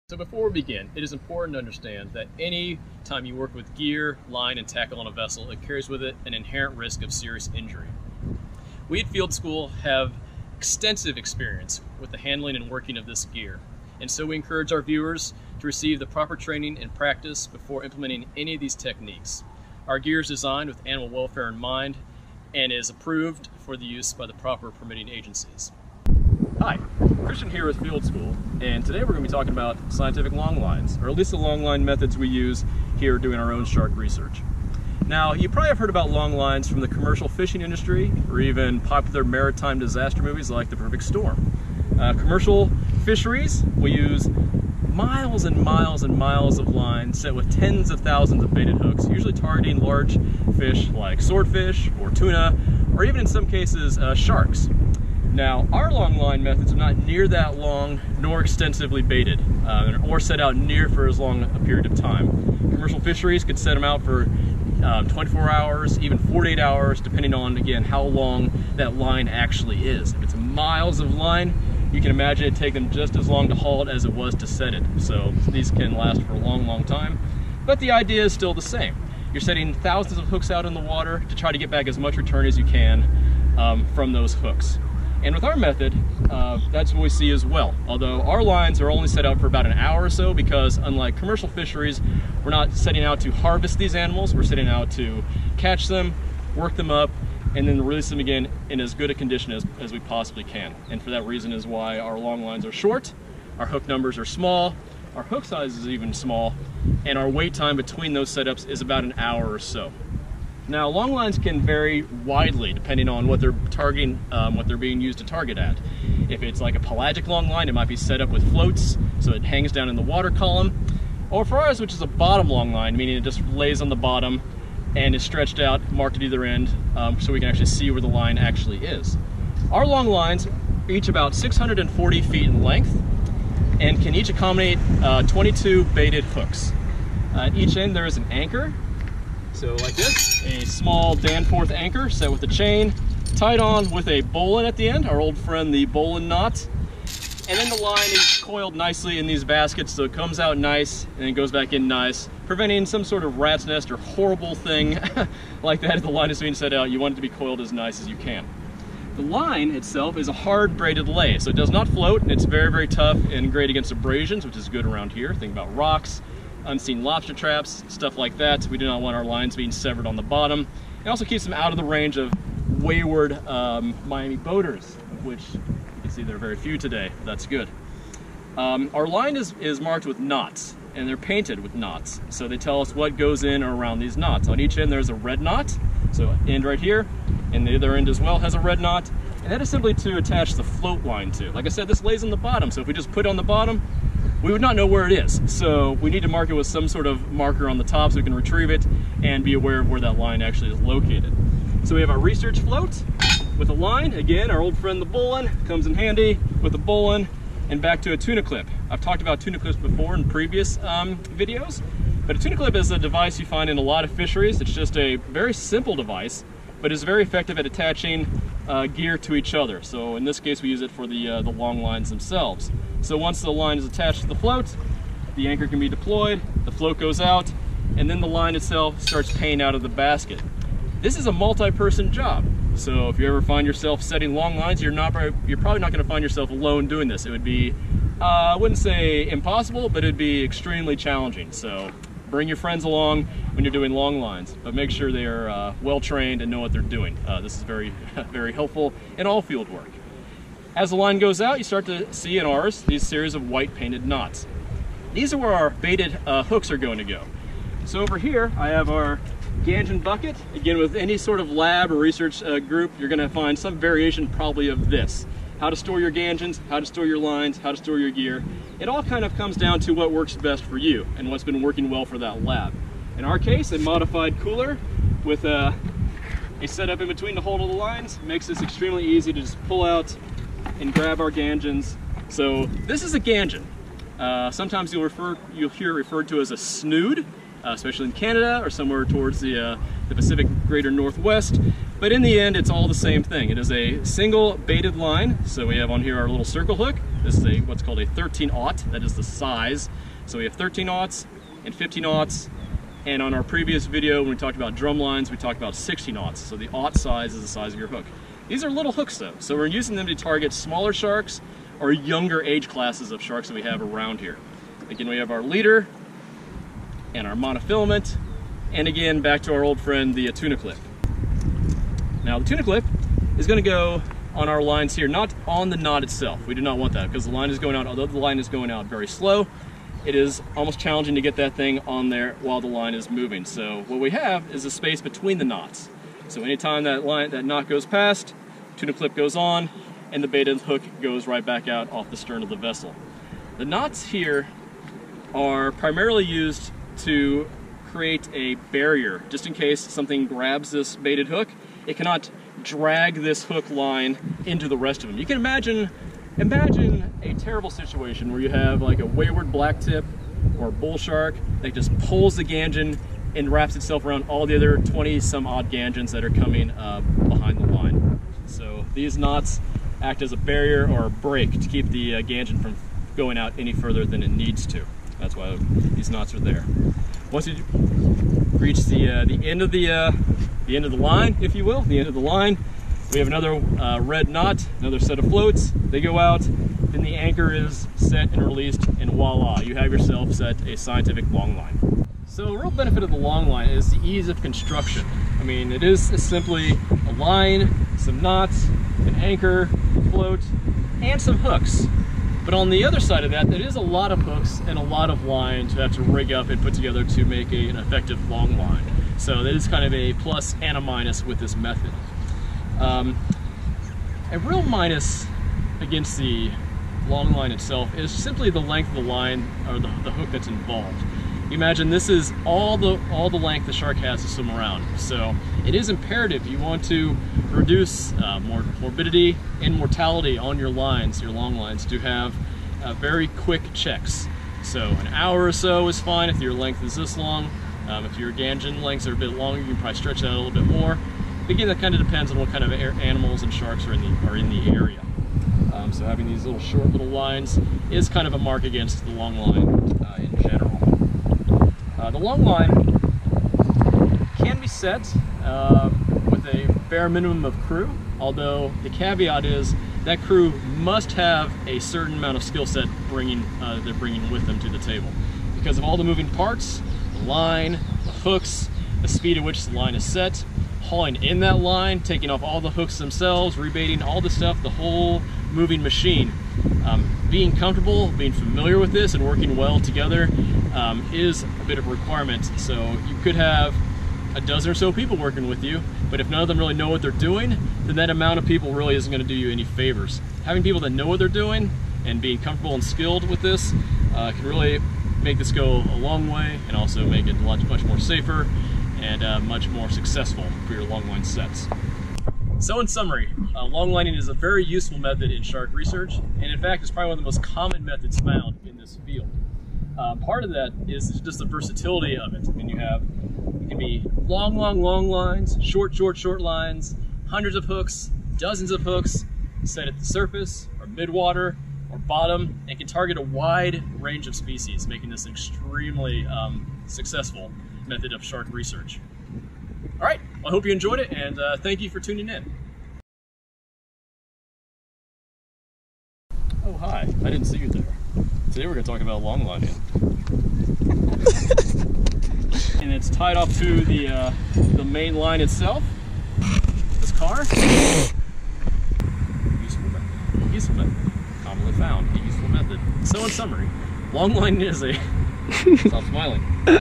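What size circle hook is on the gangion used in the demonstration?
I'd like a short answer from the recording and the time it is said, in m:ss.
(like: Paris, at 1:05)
13 aught, at 4:58.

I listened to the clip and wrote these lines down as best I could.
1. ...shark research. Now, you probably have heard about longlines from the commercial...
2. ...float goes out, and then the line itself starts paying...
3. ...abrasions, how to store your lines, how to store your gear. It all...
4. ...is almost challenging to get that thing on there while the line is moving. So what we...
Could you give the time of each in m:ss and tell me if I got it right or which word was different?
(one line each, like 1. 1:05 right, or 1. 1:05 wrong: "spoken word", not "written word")
1. 0:33 right
2. 3:46 right
3. 4:26 wrong: "gangions", not "abrasions"
4. 5:30 right.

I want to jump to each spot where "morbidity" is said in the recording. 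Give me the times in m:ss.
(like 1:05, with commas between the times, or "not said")
7:08.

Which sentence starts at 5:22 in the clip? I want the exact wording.
Now the tuna clip is gonna go on our lines here, not on the knot itself.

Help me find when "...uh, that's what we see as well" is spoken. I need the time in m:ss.
1:26.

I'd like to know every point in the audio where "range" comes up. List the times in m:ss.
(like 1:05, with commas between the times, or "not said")
2:51, 8:43.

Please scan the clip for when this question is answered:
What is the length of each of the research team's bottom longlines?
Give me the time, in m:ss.
2:11.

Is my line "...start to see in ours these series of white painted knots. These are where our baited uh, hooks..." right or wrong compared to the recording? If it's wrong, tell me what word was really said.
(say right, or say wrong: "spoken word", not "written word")
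right.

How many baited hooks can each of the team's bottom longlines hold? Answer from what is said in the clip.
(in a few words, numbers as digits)
22.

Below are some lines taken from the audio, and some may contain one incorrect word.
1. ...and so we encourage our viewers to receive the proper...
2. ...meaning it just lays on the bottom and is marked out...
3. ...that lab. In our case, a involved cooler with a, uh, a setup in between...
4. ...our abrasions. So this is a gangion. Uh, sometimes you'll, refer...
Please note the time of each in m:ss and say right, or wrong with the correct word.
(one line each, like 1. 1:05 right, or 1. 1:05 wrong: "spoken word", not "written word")
1. 0:14 right
2. 2:02 wrong: "stretched", not "marked"
3. 4:32 wrong: "modified", not "involved"
4. 4:41 wrong: "gangions", not "abrasions".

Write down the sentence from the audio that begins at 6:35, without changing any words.
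I mean, it is simply a line, some knots, an anchor, a float, and some hooks.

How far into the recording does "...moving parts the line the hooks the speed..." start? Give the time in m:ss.
7:46.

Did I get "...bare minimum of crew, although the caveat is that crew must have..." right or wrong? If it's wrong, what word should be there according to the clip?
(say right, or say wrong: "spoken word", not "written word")
right.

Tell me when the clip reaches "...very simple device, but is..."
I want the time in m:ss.
3:35.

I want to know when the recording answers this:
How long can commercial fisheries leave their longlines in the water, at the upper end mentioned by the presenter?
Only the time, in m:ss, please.
1:06.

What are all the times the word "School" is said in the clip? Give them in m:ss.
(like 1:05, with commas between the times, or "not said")
0:09, 0:28.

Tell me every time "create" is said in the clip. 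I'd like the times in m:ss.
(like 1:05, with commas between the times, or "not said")
5:47.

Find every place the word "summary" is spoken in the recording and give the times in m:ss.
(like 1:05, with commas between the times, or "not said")
8:22, 9:13.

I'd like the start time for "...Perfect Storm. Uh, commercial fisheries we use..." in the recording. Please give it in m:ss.
0:40.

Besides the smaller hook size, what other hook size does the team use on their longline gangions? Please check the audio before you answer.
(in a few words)
15 aught.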